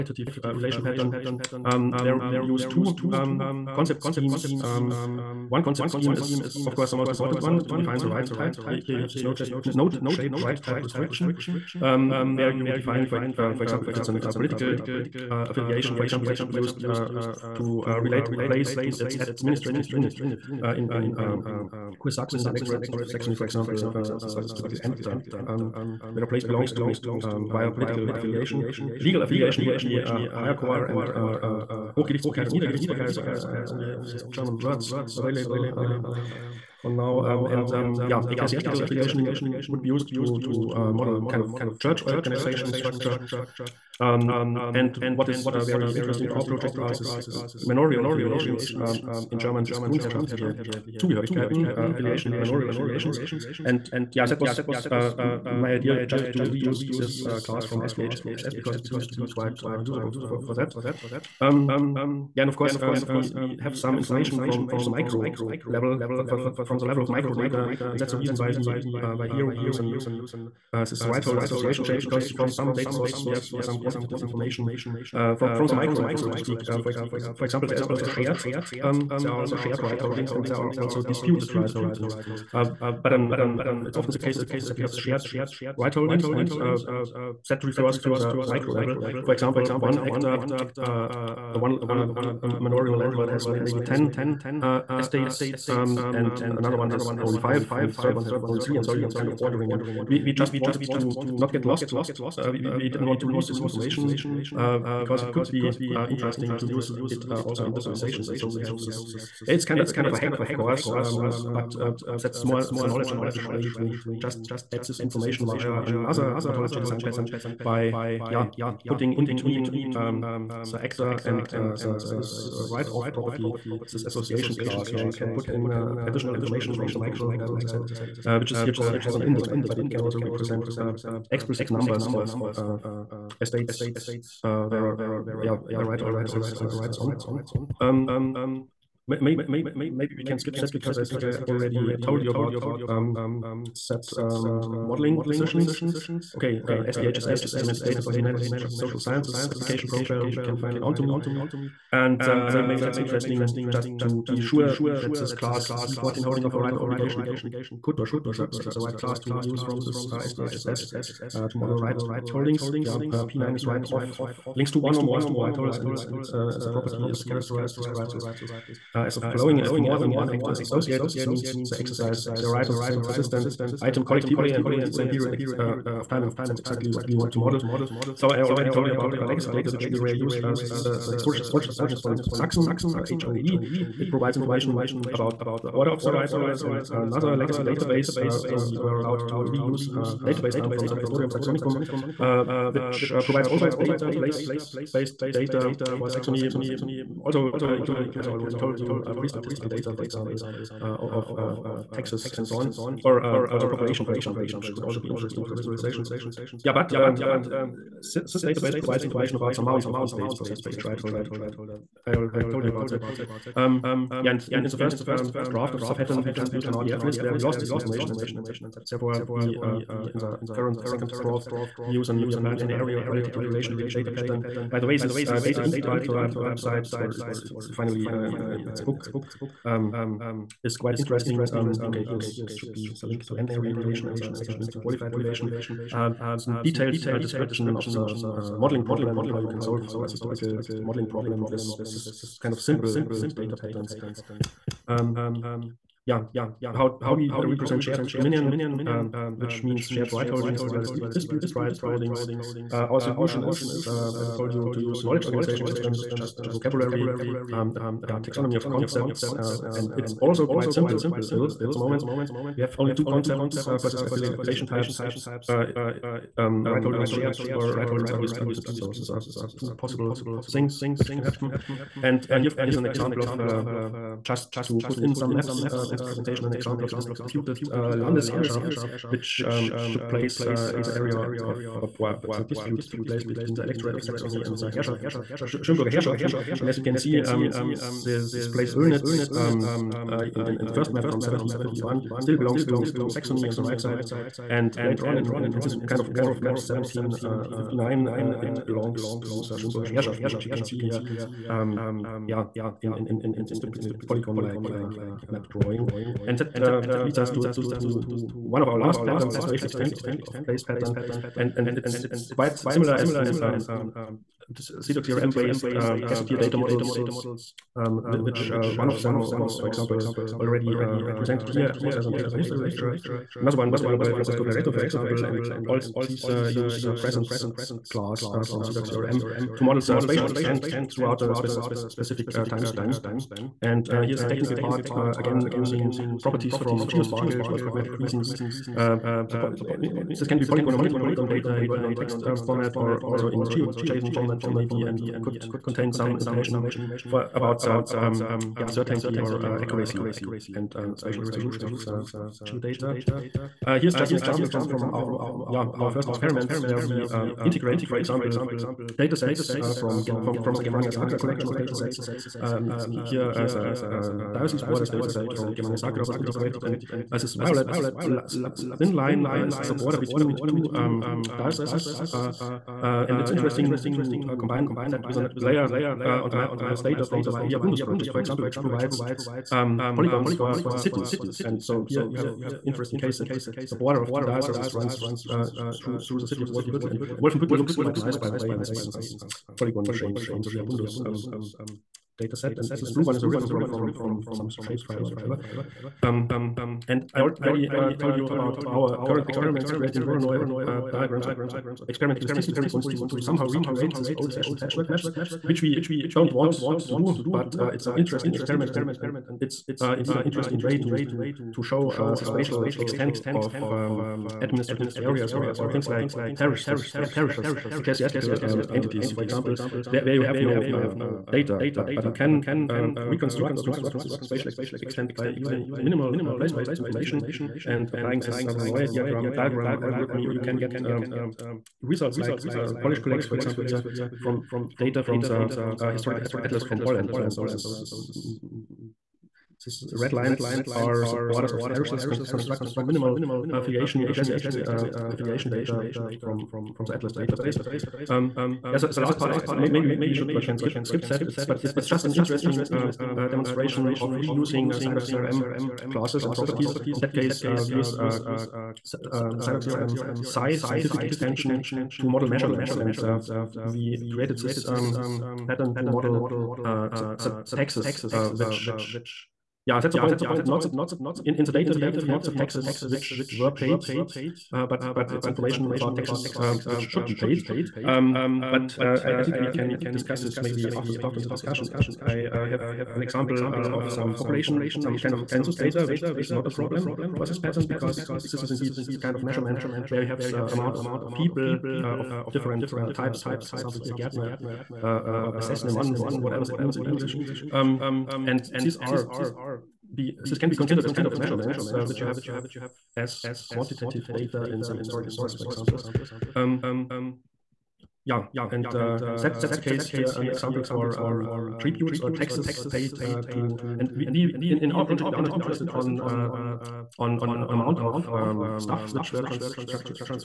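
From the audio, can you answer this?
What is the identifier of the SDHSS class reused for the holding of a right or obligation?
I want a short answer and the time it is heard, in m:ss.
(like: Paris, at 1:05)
C14, at 2:35.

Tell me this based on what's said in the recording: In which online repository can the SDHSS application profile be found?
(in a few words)
OntoME.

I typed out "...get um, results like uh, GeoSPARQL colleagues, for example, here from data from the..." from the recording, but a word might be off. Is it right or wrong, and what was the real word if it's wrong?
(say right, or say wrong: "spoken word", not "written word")
wrong: "Polish", not "GeoSPARQL".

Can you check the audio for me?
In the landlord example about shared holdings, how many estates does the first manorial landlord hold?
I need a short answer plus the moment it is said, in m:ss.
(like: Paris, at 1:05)
10, at 1:33.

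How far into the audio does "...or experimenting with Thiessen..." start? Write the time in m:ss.
6:41.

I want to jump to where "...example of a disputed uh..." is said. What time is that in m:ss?
4:36.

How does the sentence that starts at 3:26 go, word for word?
Yeah, but um, this database provides information about the amount of estates possessed by each right holder.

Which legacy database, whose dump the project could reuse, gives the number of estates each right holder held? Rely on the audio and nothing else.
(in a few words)
Repertorium Saxonicum.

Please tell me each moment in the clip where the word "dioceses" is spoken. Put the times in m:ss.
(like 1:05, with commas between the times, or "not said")
6:04, 6:11, 6:24.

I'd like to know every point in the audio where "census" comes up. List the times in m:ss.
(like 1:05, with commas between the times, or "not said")
8:05.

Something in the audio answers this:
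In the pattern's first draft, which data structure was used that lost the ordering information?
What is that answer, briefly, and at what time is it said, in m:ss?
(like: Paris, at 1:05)
RDF list, at 3:36.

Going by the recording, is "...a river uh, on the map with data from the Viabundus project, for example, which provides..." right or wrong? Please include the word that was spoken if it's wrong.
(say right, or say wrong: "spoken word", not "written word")
wrong: "layer", not "river".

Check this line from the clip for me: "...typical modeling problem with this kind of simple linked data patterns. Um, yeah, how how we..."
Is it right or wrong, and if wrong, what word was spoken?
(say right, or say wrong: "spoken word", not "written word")
right.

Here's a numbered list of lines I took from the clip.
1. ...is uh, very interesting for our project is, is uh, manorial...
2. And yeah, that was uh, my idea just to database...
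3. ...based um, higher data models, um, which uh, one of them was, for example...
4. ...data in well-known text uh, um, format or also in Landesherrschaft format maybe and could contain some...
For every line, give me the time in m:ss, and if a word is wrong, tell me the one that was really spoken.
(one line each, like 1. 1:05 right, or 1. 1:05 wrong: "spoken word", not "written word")
1. 0:45 right
2. 0:53 wrong: "reuse", not "database"
3. 5:15 wrong: "gazetteer", not "higher"
4. 5:41 wrong: "GeoJSON", not "Landesherrschaft".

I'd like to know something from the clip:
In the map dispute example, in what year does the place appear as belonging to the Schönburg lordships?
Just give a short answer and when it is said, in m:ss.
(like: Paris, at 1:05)
1759, at 4:56.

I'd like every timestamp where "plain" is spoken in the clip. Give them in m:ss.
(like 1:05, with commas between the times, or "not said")
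not said.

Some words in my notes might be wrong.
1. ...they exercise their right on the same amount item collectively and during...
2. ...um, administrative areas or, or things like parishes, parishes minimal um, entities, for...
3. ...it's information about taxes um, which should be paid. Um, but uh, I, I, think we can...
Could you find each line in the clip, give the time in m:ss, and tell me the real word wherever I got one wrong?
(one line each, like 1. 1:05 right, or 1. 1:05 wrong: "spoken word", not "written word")
1. 2:51 wrong: "persistent", not "amount"
2. 6:53 wrong: "ecclesiastical", not "minimal"
3. 7:55 right.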